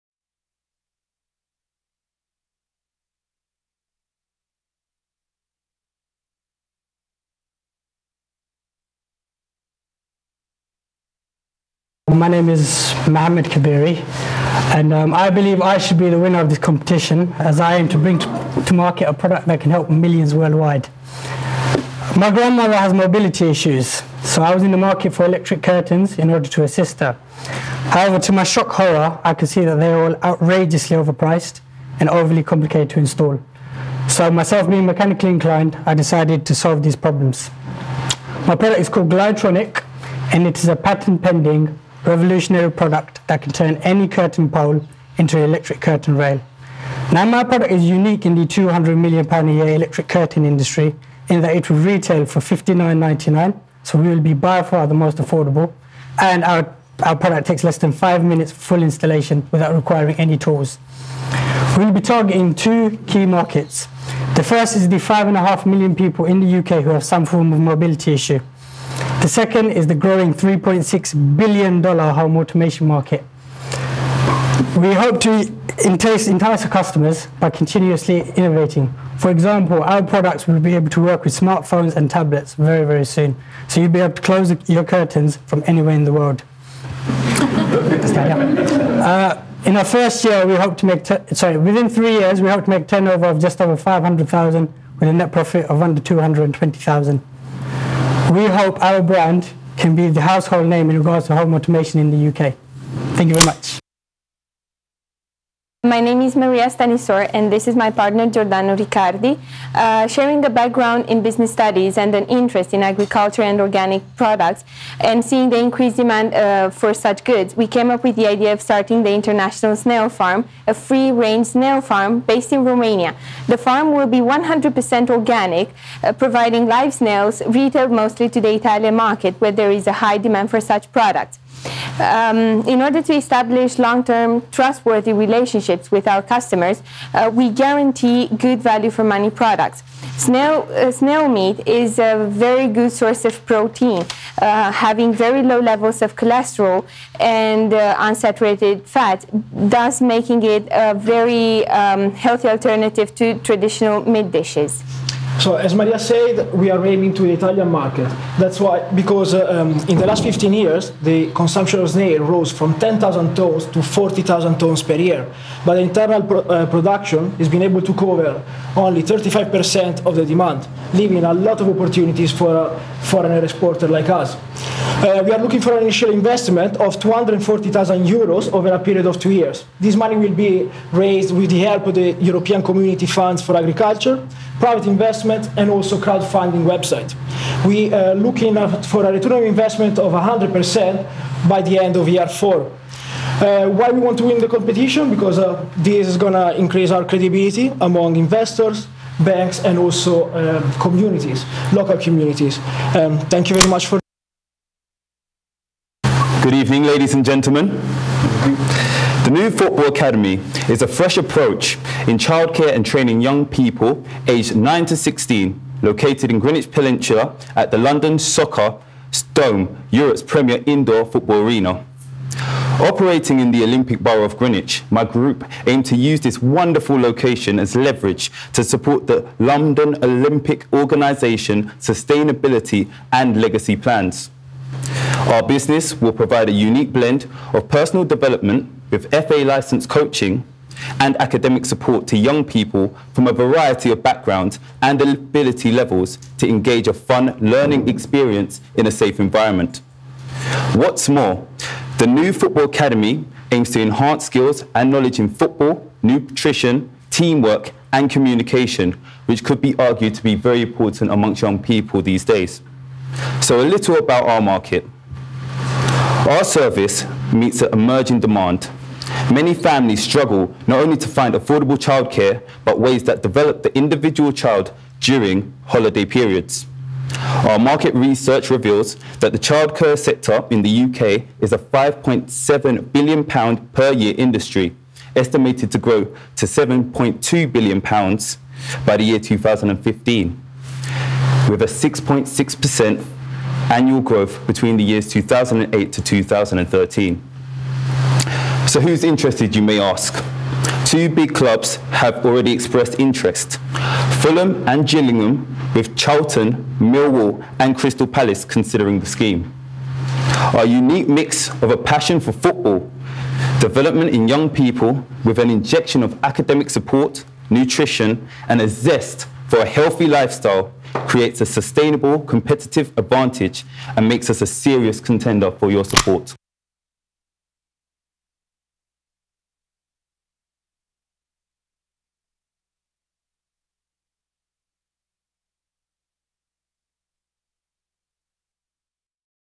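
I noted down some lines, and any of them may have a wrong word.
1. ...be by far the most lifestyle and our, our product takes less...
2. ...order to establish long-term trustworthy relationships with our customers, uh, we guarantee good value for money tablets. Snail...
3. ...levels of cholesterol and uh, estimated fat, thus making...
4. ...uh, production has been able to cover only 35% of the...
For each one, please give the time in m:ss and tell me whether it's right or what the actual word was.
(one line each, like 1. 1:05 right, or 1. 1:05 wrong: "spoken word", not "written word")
1. 0:54 wrong: "affordable", not "lifestyle"
2. 2:12 wrong: "products", not "tablets"
3. 2:25 wrong: "unsaturated", not "estimated"
4. 2:46 right.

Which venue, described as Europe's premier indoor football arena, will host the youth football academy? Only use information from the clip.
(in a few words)
London Soccer Dome.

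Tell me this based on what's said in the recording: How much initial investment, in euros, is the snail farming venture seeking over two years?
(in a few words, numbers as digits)
240,000 euros.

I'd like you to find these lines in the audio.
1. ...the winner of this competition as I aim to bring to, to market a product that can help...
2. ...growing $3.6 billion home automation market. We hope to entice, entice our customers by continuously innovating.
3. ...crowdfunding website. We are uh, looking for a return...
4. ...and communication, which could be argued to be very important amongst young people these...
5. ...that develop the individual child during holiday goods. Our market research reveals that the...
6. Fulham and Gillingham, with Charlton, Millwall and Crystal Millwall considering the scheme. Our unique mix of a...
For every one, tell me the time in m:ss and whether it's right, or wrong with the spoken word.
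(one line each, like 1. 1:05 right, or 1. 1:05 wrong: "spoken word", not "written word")
1. 0:16 right
2. 1:09 right
3. 3:05 right
4. 4:17 right
5. 4:33 wrong: "periods", not "goods"
6. 5:04 wrong: "Palace", not "Millwall".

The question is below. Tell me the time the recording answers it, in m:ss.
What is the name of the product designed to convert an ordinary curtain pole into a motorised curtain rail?
0:39.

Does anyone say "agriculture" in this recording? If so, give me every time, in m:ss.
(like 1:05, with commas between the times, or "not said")
1:52, 3:03.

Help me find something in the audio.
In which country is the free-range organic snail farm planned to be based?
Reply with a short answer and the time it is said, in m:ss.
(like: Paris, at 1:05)
Romania, at 2:02.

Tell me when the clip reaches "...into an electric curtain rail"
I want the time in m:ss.
0:45.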